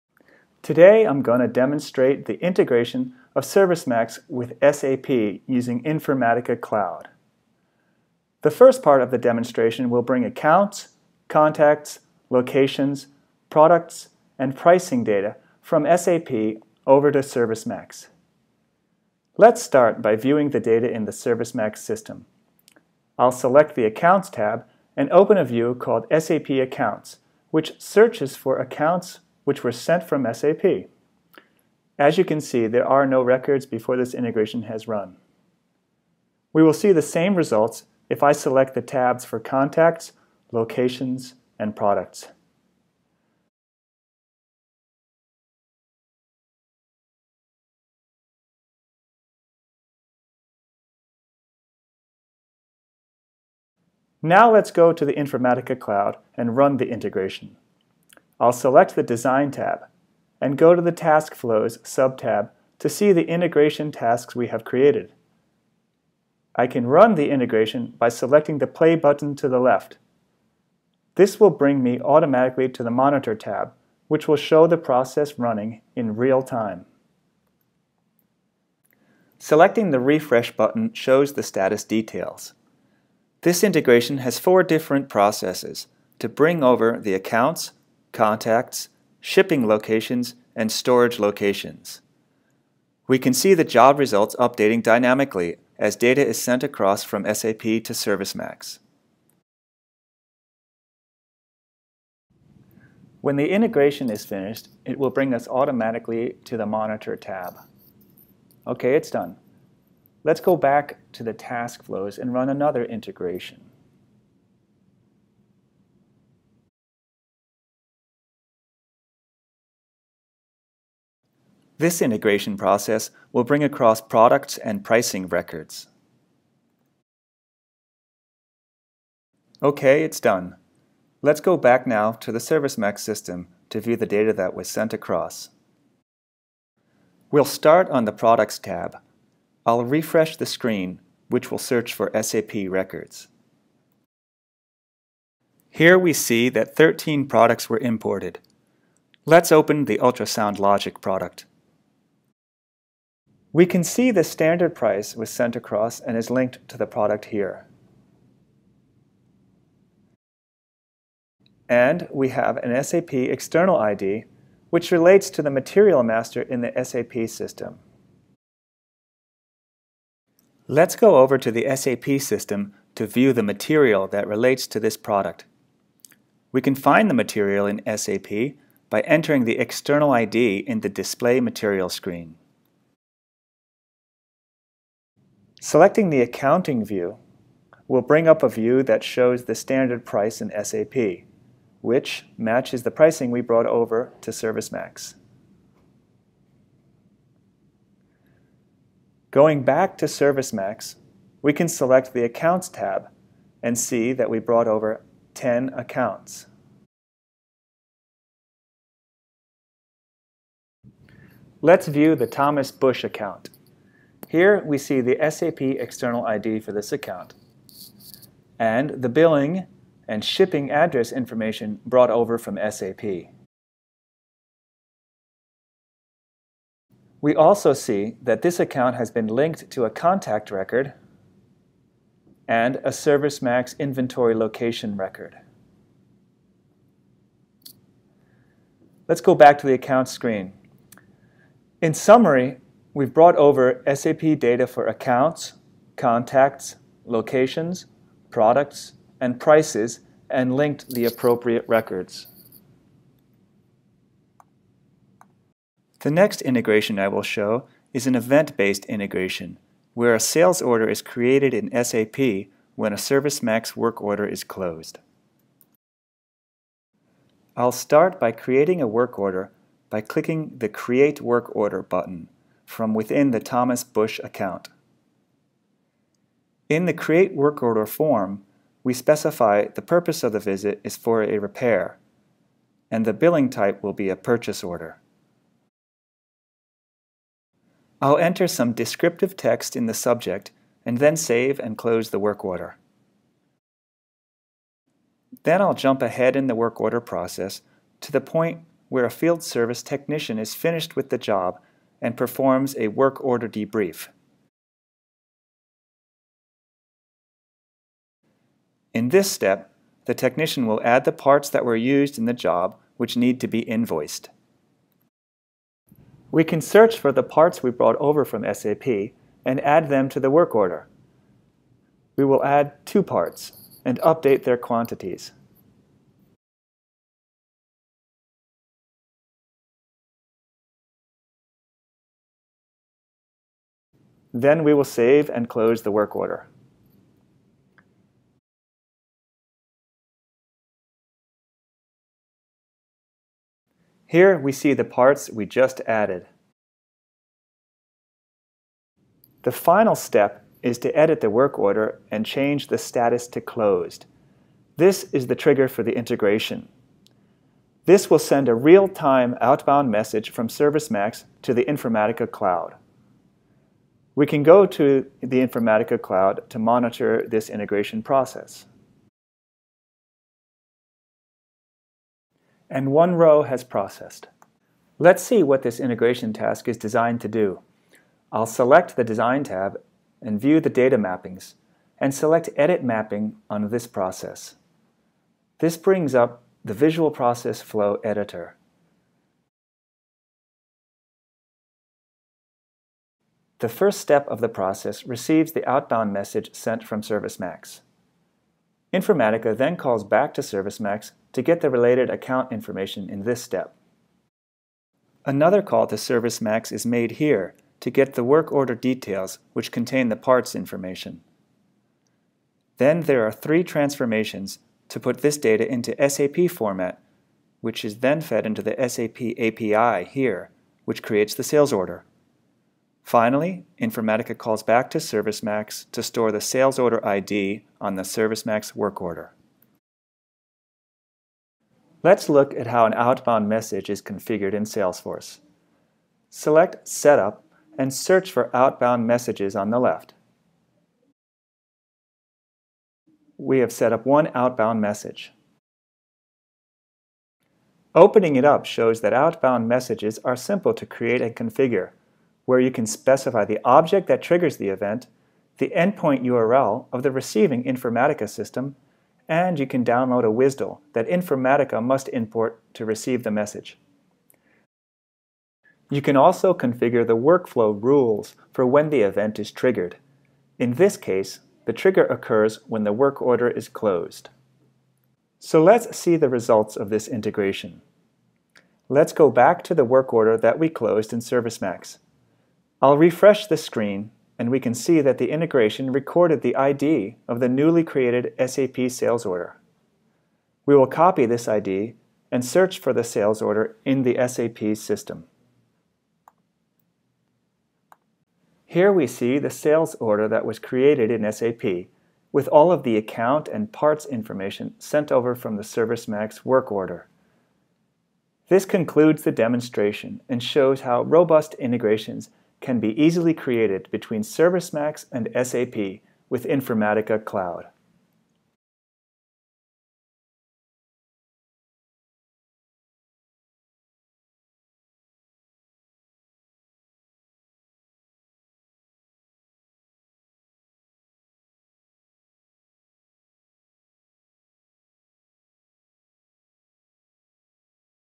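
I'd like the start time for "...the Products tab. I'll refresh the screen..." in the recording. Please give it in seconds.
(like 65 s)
138 s.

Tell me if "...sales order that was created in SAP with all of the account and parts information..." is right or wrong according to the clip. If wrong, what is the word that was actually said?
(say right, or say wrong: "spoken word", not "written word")
right.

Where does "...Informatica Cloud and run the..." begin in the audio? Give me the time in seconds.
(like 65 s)
55 s.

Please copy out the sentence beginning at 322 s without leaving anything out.
We will add two parts and update their quantities.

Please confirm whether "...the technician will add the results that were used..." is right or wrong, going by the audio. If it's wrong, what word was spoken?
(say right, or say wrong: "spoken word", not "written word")
wrong: "parts", not "results".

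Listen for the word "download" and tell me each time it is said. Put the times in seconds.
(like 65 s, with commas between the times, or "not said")
459 s.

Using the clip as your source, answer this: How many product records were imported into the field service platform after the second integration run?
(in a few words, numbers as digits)
13.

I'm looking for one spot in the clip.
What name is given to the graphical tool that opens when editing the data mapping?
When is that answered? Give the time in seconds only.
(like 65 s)
386 s.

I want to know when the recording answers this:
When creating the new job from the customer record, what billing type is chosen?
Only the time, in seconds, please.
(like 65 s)
284 s.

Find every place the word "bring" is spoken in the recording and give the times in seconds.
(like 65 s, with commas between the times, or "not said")
10 s, 71 s, 86 s, 105 s, 123 s, 188 s, 385 s.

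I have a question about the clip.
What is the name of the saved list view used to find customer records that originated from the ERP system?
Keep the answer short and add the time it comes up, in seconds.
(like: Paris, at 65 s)
SAP Accounts, at 26 s.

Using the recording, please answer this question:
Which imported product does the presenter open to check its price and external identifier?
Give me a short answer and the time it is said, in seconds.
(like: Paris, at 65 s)
ultrasound logic, at 149 s.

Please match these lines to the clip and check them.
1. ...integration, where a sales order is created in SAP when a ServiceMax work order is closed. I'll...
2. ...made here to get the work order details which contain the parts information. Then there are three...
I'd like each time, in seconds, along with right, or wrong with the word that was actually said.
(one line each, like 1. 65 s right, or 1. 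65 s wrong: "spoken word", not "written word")
1. 258 s right
2. 406 s right.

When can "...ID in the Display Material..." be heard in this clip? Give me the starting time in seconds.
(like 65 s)
180 s.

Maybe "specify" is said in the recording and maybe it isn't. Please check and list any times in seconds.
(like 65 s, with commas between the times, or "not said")
278 s, 452 s.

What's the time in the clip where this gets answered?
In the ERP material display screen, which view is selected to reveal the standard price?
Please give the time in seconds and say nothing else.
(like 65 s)
186 s.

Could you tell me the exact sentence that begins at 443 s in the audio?
We have set up one outbound message.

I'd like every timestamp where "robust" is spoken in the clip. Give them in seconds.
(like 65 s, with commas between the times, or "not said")
511 s.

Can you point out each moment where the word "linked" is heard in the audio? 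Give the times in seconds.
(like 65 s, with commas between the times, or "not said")
156 s, 229 s, 250 s.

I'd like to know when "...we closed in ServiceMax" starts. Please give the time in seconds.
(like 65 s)
480 s.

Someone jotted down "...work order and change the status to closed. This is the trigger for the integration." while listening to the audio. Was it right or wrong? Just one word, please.
right.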